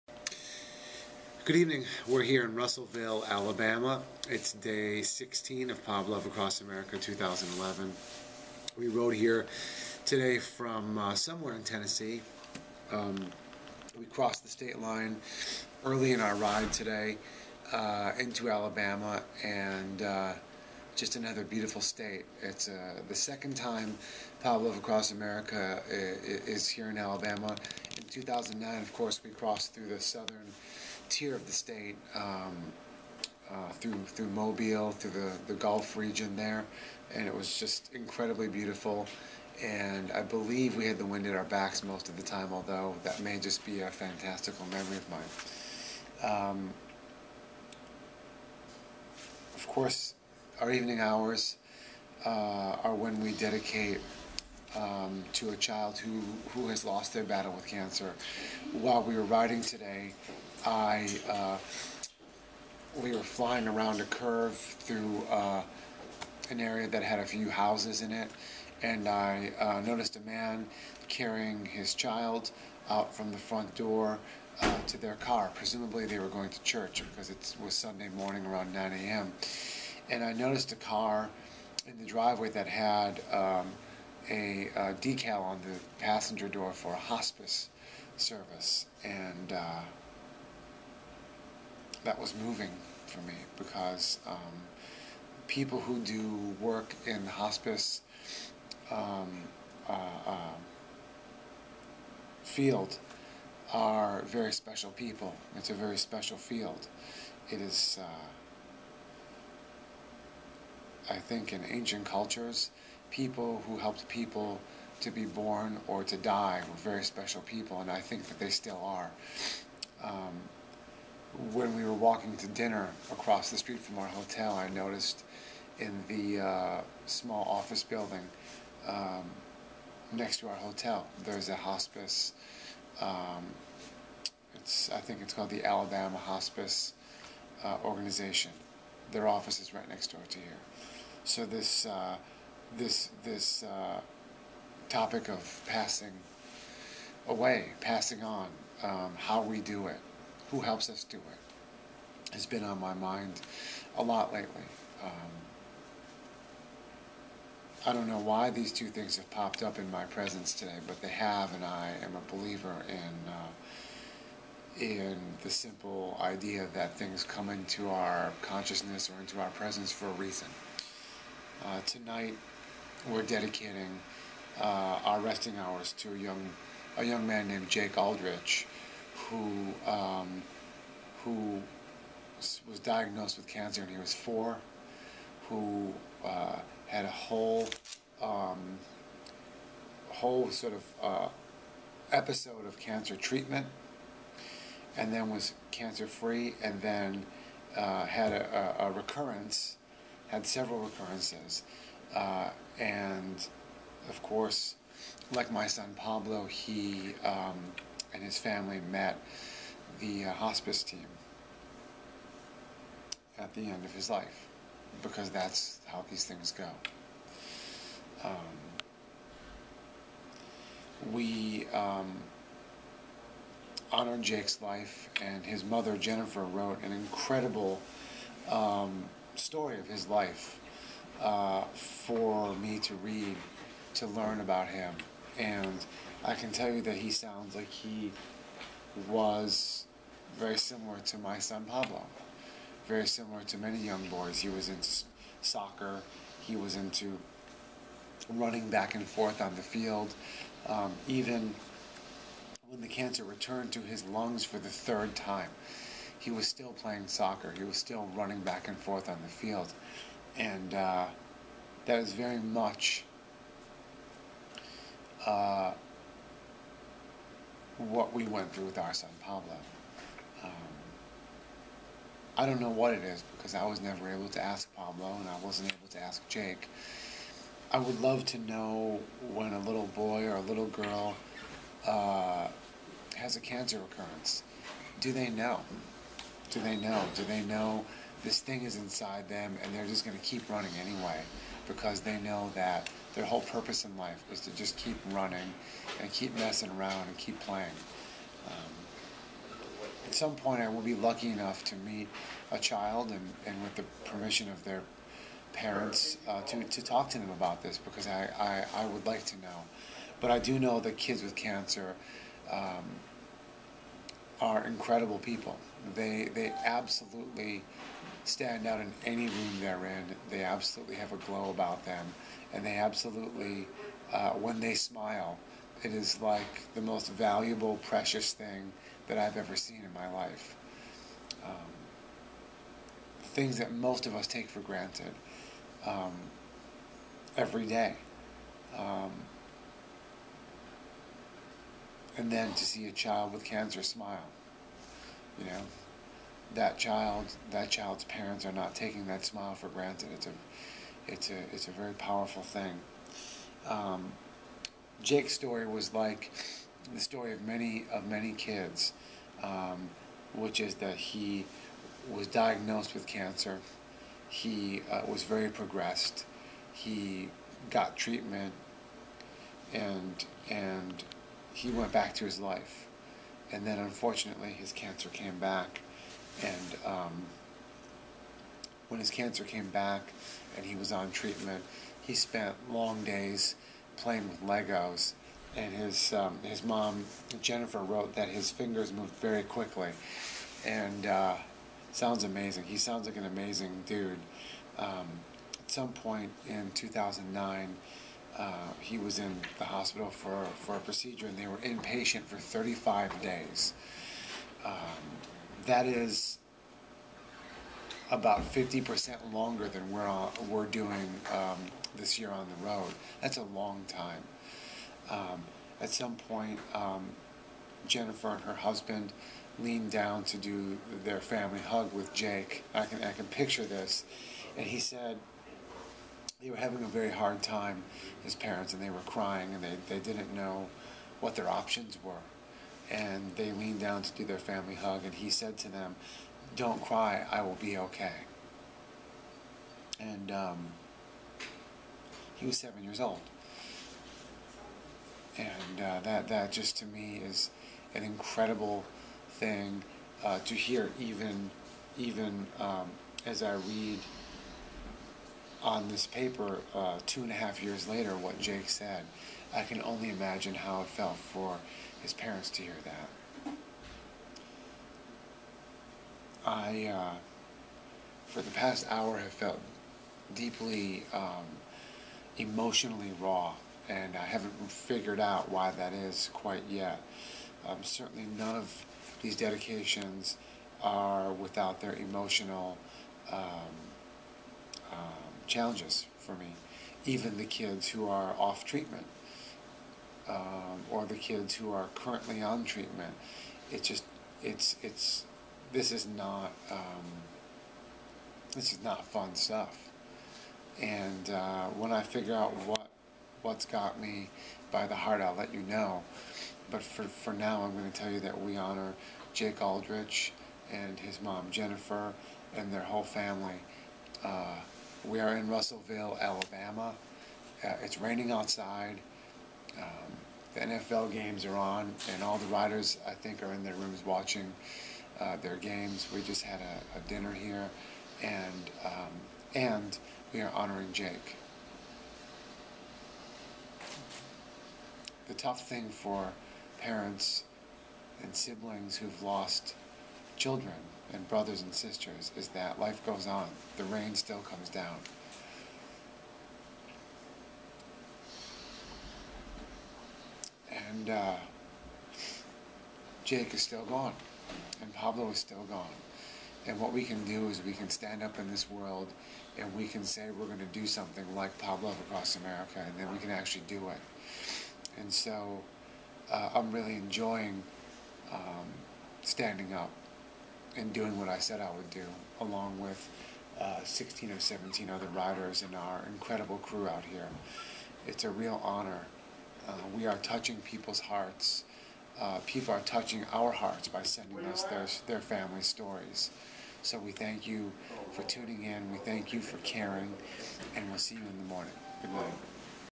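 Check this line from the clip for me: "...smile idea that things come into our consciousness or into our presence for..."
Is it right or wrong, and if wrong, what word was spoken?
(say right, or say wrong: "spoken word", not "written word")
wrong: "simple", not "smile".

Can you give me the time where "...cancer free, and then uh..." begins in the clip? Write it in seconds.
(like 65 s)
195 s.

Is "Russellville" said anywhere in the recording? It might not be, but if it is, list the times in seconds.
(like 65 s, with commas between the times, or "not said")
2 s, 515 s.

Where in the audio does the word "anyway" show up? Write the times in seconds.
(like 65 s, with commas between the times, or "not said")
290 s.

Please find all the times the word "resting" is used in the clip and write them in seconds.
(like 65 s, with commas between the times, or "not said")
175 s.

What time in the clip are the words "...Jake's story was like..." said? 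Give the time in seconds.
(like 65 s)
355 s.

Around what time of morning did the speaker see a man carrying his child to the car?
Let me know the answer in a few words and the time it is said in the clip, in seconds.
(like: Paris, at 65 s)
9 a.m., at 78 s.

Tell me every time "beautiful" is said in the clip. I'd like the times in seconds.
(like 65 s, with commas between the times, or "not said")
21 s, 38 s.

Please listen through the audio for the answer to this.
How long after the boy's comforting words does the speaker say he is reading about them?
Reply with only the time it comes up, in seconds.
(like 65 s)
457 s.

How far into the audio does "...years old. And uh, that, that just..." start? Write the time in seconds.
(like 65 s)
442 s.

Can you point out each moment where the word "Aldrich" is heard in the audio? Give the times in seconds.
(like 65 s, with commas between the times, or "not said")
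177 s, 509 s.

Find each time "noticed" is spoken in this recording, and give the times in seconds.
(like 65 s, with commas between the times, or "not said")
69 s, 80 s, 124 s.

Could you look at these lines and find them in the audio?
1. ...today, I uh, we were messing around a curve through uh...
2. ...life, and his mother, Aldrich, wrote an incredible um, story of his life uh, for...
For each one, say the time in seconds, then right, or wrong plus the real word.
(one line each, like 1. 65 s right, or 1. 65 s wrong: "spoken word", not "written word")
1. 59 s wrong: "flying", not "messing"
2. 224 s wrong: "Jennifer", not "Aldrich".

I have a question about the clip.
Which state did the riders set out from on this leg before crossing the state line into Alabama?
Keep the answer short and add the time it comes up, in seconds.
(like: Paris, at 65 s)
Tennessee, at 11 s.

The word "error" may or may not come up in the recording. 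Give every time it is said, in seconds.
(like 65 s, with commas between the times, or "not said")
not said.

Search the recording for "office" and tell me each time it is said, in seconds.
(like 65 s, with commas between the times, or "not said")
127 s, 139 s.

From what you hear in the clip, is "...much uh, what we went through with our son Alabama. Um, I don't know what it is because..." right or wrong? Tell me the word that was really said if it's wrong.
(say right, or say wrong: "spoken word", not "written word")
wrong: "Pablo", not "Alabama".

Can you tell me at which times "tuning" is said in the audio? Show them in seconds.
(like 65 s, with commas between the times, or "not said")
588 s.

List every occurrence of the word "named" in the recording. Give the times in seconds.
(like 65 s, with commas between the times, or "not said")
177 s.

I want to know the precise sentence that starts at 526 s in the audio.
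We just had a, a dinner here, and um, and we are honoring Jake.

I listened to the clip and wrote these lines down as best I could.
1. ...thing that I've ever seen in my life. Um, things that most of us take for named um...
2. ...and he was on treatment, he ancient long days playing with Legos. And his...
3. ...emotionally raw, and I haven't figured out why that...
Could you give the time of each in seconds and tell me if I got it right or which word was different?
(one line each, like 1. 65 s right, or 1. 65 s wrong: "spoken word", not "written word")
1. 328 s wrong: "granted", not "named"
2. 380 s wrong: "spent", not "ancient"
3. 472 s right.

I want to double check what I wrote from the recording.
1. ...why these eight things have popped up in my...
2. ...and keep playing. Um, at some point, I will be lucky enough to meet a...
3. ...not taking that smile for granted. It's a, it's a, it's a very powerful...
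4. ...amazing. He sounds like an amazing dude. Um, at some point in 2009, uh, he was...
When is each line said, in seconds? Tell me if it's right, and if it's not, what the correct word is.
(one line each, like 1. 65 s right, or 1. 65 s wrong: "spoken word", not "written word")
1. 158 s wrong: "two", not "eight"
2. 297 s right
3. 348 s right
4. 392 s right.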